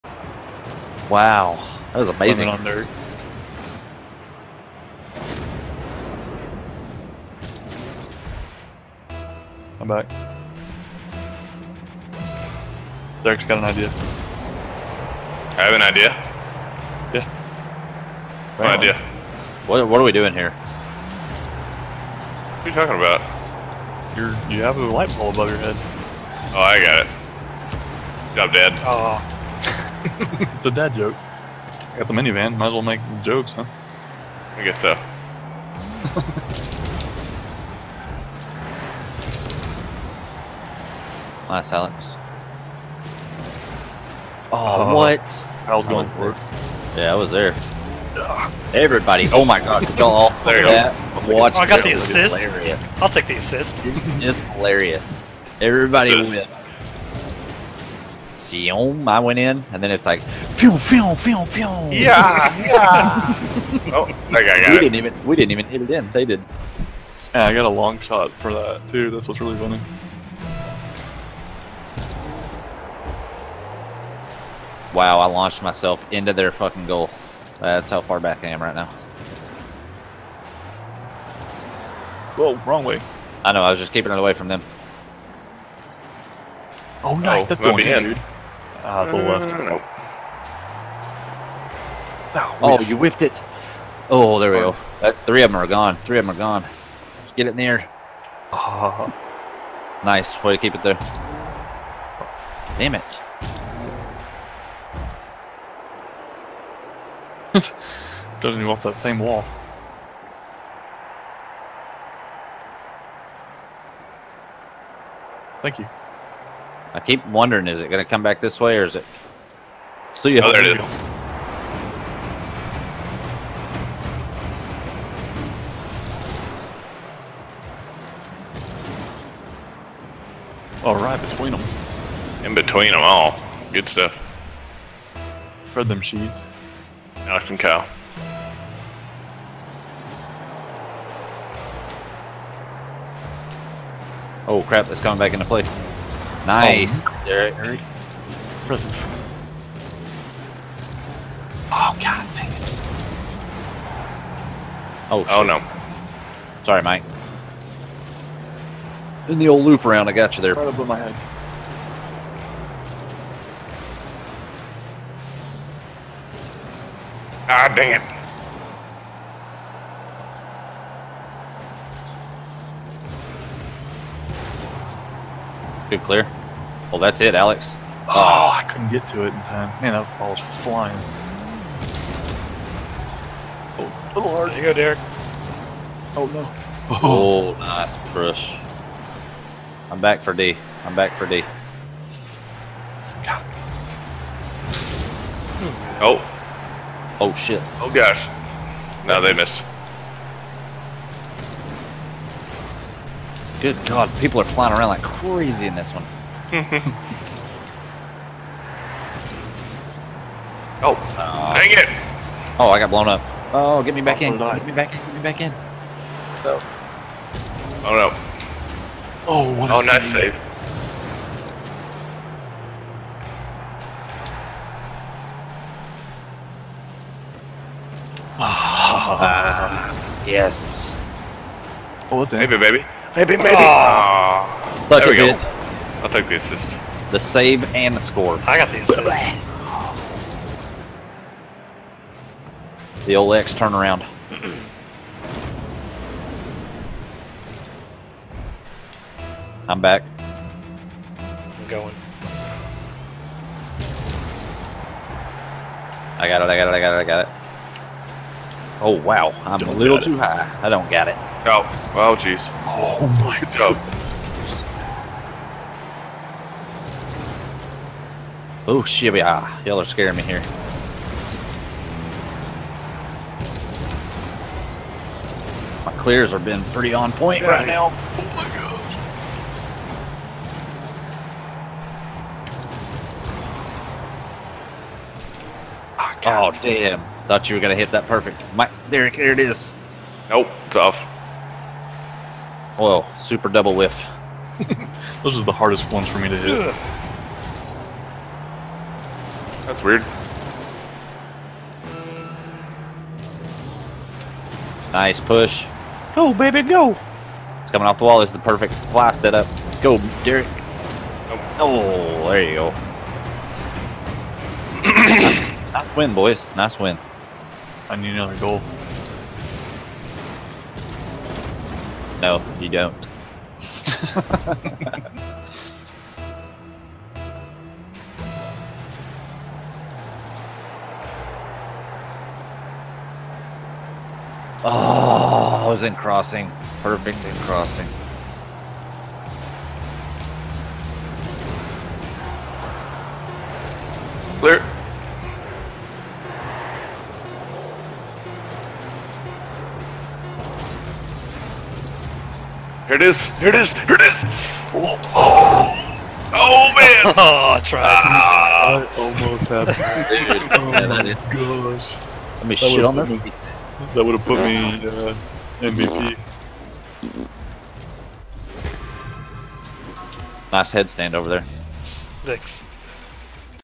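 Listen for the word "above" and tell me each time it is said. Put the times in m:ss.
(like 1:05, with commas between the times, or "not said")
0:25, 2:40.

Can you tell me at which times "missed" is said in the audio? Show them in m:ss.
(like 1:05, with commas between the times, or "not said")
3:19.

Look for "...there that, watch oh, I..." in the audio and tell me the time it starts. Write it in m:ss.
0:50.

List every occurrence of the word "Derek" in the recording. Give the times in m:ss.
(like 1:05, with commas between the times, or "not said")
0:13, 2:27, 3:04, 5:10.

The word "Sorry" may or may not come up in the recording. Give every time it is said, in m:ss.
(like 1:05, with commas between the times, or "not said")
2:36.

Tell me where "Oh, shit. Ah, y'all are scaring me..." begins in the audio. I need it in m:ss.
4:28.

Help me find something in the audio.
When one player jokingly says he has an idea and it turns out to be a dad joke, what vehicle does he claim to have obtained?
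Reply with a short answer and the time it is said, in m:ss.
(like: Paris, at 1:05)
The minivan, at 0:32.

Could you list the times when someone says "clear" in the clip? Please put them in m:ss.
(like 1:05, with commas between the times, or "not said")
2:56, 4:36, 5:44.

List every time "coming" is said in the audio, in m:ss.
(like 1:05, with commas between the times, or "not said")
2:24, 5:07.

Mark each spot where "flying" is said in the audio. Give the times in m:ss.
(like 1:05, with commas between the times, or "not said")
3:00, 3:24.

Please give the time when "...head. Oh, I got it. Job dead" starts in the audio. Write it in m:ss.
0:25.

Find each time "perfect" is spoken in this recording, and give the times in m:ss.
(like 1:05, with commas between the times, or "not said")
4:48, 5:08, 5:36.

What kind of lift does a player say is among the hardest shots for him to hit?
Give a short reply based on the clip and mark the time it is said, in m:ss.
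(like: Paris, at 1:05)
Super double lift, at 4:53.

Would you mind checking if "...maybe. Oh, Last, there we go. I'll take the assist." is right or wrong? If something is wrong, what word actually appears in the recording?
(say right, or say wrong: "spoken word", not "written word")
wrong: "Look", not "Last".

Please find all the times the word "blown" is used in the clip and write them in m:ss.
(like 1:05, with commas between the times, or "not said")
3:32.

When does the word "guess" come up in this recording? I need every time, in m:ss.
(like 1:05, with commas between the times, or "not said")
0:34.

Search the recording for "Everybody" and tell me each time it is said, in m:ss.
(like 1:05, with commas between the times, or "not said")
0:48, 0:55.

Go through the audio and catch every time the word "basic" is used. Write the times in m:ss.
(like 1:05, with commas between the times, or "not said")
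not said.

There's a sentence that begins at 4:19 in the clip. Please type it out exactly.
I'm don't a little too high.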